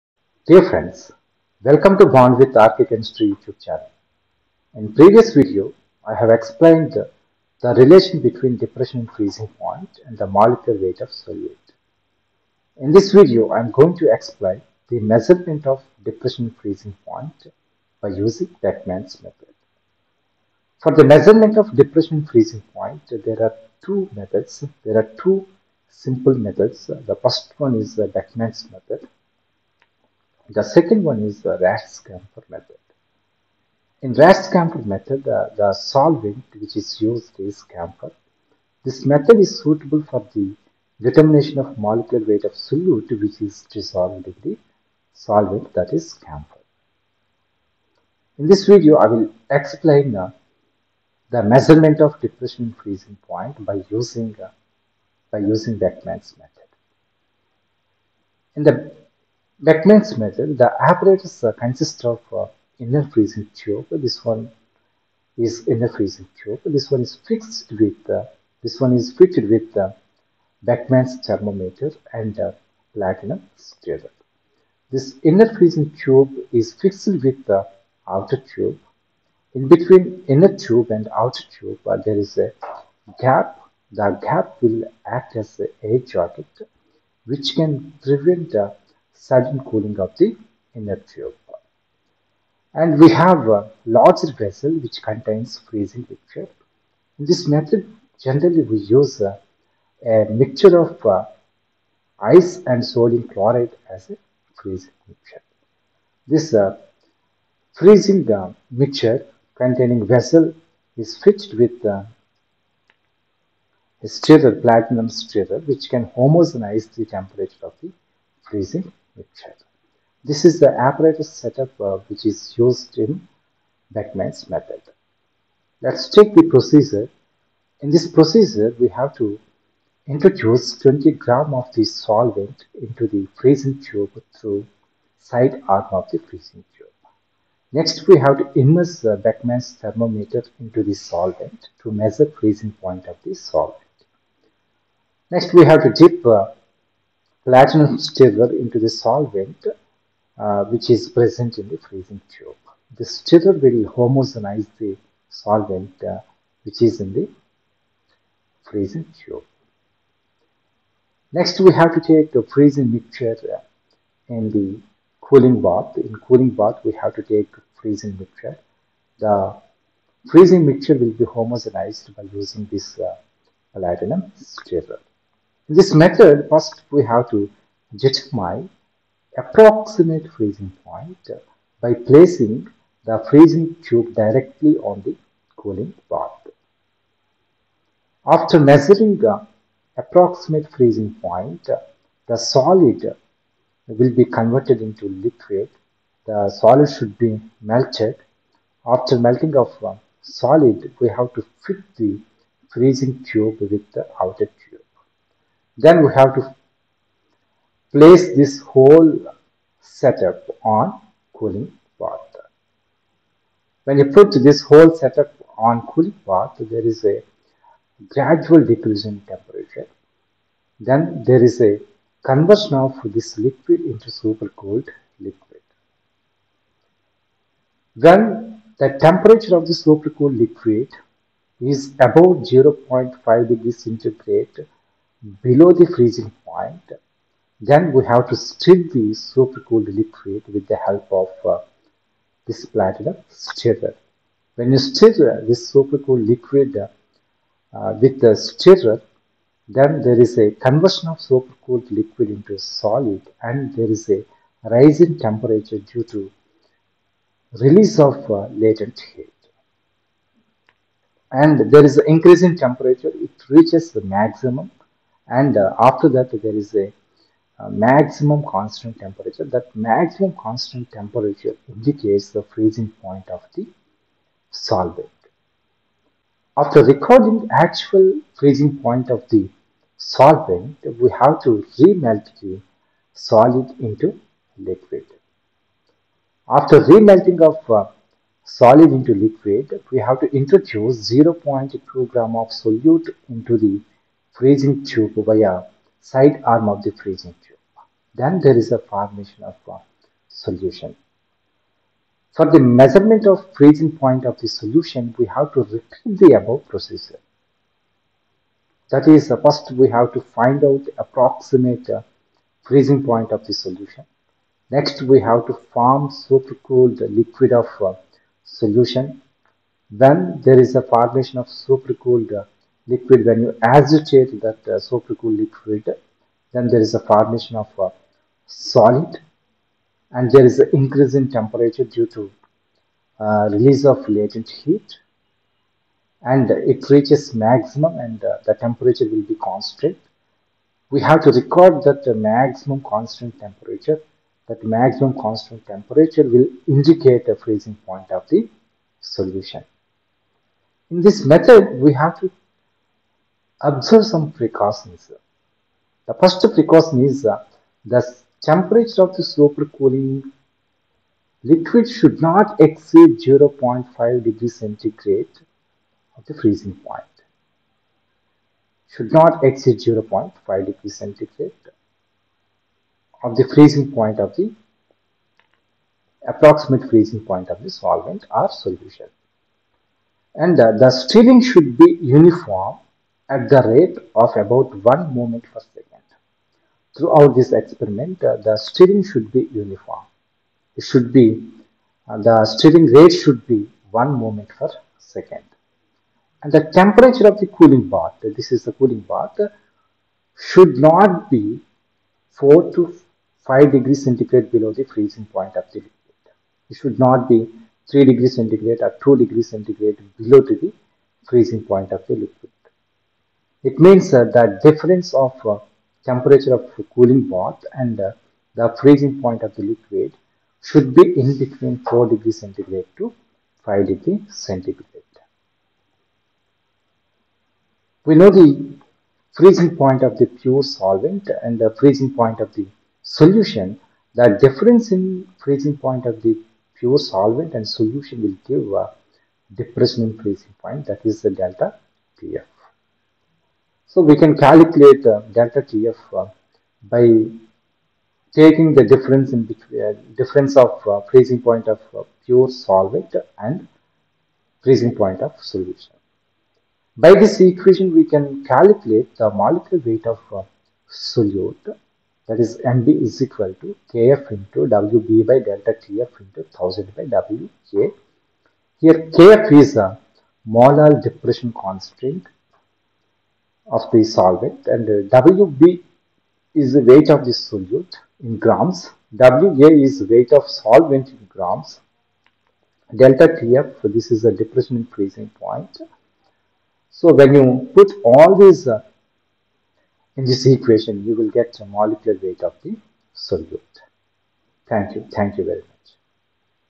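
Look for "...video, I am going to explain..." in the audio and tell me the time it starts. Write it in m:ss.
0:13.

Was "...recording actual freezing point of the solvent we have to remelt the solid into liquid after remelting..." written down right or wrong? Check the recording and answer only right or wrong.
right.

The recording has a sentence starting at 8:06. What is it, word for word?
So when you put all these uh, in this equation you will get a molecular weight of the solute.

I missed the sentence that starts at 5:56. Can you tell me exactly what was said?
The first precaution is uh, the temperature of the super cooling liquid should not exceed 0.5 degrees centigrade of the freezing point.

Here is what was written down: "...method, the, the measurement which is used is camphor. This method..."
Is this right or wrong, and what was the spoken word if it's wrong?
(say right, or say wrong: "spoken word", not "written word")
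wrong: "solvent", not "measurement".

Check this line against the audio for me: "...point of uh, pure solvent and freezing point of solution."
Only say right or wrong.
right.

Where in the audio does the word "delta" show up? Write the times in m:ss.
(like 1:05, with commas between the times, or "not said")
7:21, 7:25, 7:45, 8:02.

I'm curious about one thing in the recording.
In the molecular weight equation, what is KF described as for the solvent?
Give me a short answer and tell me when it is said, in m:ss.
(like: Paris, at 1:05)
molar depression constant, at 7:50.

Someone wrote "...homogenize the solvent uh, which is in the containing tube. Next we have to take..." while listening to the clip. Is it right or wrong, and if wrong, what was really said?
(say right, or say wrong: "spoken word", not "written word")
wrong: "freezing", not "containing".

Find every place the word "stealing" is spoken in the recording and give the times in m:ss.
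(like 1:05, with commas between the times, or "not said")
6:20.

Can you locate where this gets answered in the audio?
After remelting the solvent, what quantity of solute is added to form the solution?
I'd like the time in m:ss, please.
4:51.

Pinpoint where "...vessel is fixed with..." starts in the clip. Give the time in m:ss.
1:50.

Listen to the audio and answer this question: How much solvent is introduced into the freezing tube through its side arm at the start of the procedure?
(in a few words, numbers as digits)
20 grams.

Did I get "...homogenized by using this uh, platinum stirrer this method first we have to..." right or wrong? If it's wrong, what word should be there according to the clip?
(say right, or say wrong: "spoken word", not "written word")
right.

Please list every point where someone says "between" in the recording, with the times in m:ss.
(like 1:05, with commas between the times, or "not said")
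0:08, 1:19, 7:01, 7:29.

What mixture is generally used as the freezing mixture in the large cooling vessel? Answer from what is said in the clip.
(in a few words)
ice and sodium chloride.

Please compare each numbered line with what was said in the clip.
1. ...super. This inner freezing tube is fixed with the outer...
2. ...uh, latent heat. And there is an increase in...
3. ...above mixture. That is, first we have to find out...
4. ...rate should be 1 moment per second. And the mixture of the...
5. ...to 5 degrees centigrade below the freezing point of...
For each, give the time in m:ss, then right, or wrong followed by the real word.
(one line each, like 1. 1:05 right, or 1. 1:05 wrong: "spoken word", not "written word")
1. 1:13 wrong: "stirrer", not "super"
2. 4:18 right
3. 5:06 wrong: "procedure", not "mixture"
4. 6:32 wrong: "temperature", not "mixture"
5. 6:42 right.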